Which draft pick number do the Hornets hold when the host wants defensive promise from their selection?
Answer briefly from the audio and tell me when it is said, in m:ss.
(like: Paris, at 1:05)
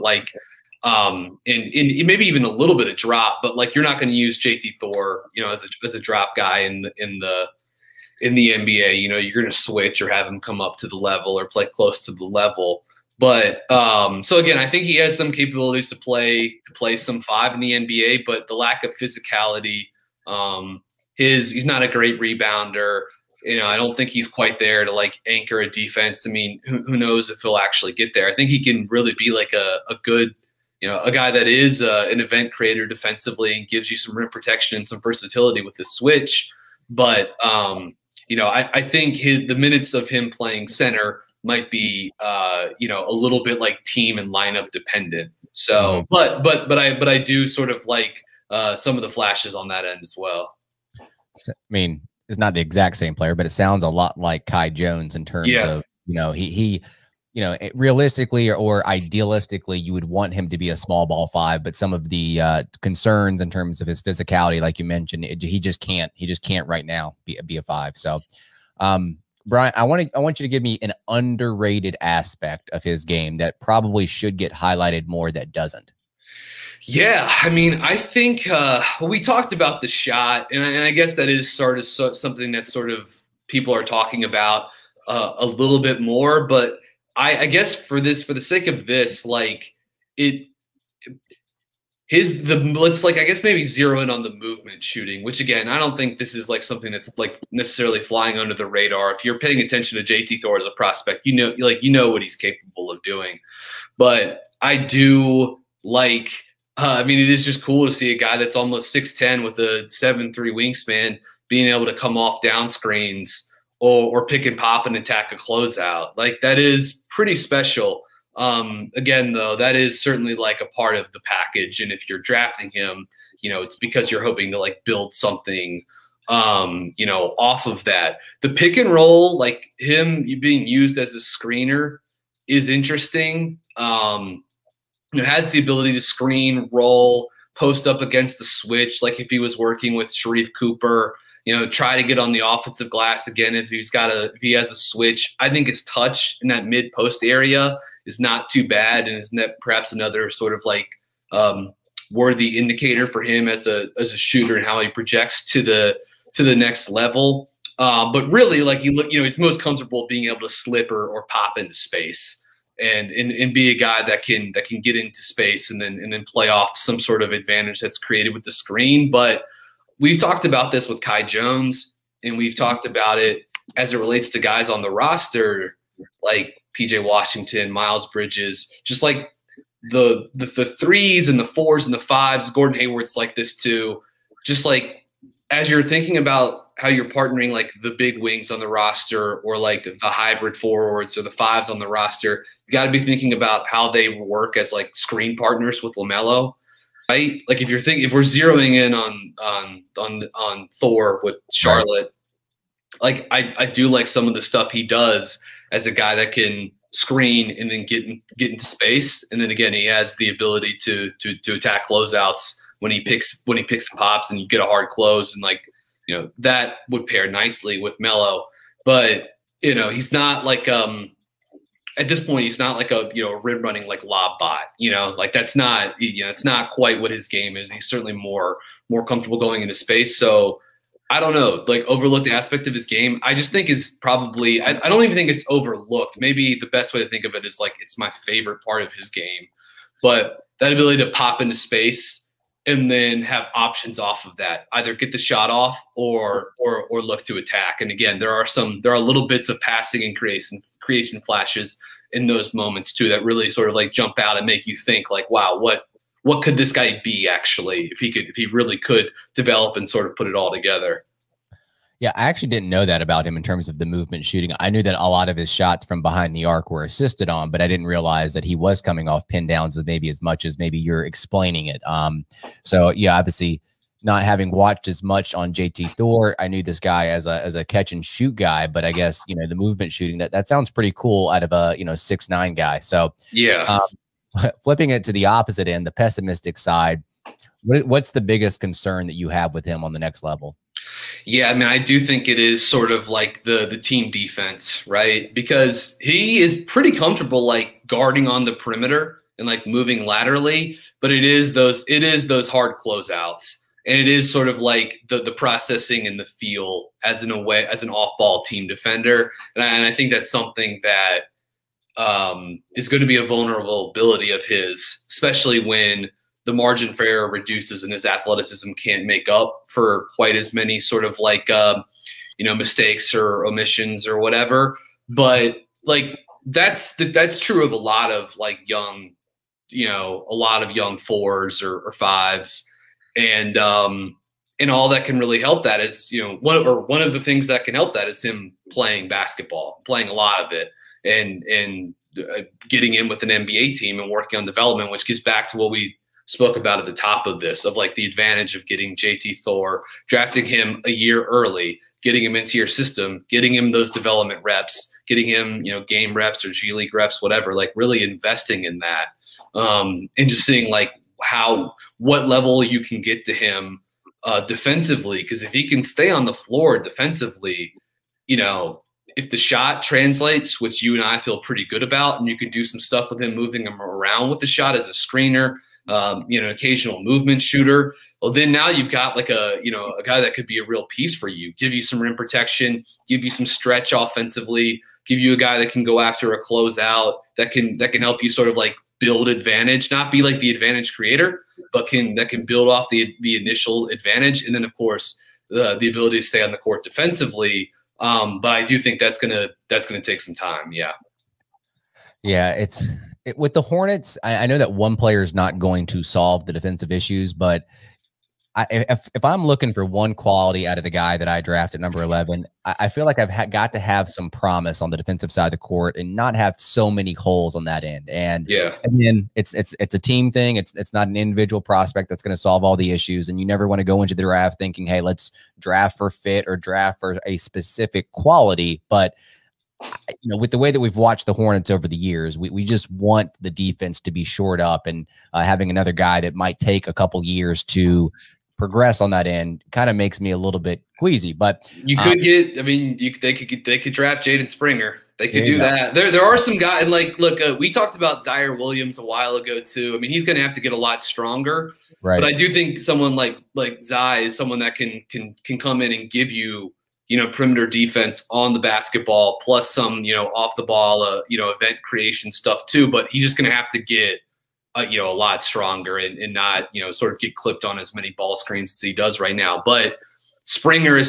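11, at 6:52.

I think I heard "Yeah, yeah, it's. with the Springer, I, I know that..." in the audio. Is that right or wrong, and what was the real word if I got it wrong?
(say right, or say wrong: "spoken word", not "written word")
wrong: "Hornets", not "Springer".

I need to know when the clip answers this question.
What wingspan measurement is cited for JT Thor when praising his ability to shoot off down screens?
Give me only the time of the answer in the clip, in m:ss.
1:49.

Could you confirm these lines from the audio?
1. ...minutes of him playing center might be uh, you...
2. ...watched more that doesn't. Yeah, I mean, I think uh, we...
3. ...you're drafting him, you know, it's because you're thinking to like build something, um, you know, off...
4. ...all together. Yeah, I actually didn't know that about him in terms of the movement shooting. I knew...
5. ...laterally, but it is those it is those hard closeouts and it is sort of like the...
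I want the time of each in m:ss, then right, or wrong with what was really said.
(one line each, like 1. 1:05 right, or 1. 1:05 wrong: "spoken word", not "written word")
1. 0:39 right
2. 1:14 wrong: "highlighted", not "watched"
3. 2:02 wrong: "hoping", not "thinking"
4. 4:20 right
5. 5:00 right.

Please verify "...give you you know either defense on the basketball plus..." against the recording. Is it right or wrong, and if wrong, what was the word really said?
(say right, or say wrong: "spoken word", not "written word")
wrong: "perimeter", not "either".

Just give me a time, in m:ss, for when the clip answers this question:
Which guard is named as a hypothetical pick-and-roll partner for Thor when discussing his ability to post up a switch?
2:20.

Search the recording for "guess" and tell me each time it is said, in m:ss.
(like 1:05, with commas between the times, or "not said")
1:20, 1:27, 1:33, 4:38.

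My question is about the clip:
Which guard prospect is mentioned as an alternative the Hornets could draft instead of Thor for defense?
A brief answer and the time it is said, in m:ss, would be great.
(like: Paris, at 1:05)
Jaden Springer, at 7:24.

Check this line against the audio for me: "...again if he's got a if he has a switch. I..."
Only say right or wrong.
right.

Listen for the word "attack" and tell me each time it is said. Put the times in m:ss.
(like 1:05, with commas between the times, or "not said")
1:54, 3:31, 4:07.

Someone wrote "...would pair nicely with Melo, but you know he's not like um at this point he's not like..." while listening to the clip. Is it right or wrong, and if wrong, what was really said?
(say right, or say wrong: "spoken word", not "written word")
right.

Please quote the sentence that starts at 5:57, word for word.
Like really investing in that, um, and just seeing like how what level you can get to him uh, defensively.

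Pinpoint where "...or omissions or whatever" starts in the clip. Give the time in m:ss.
5:23.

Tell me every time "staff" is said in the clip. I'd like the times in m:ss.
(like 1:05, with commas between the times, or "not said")
not said.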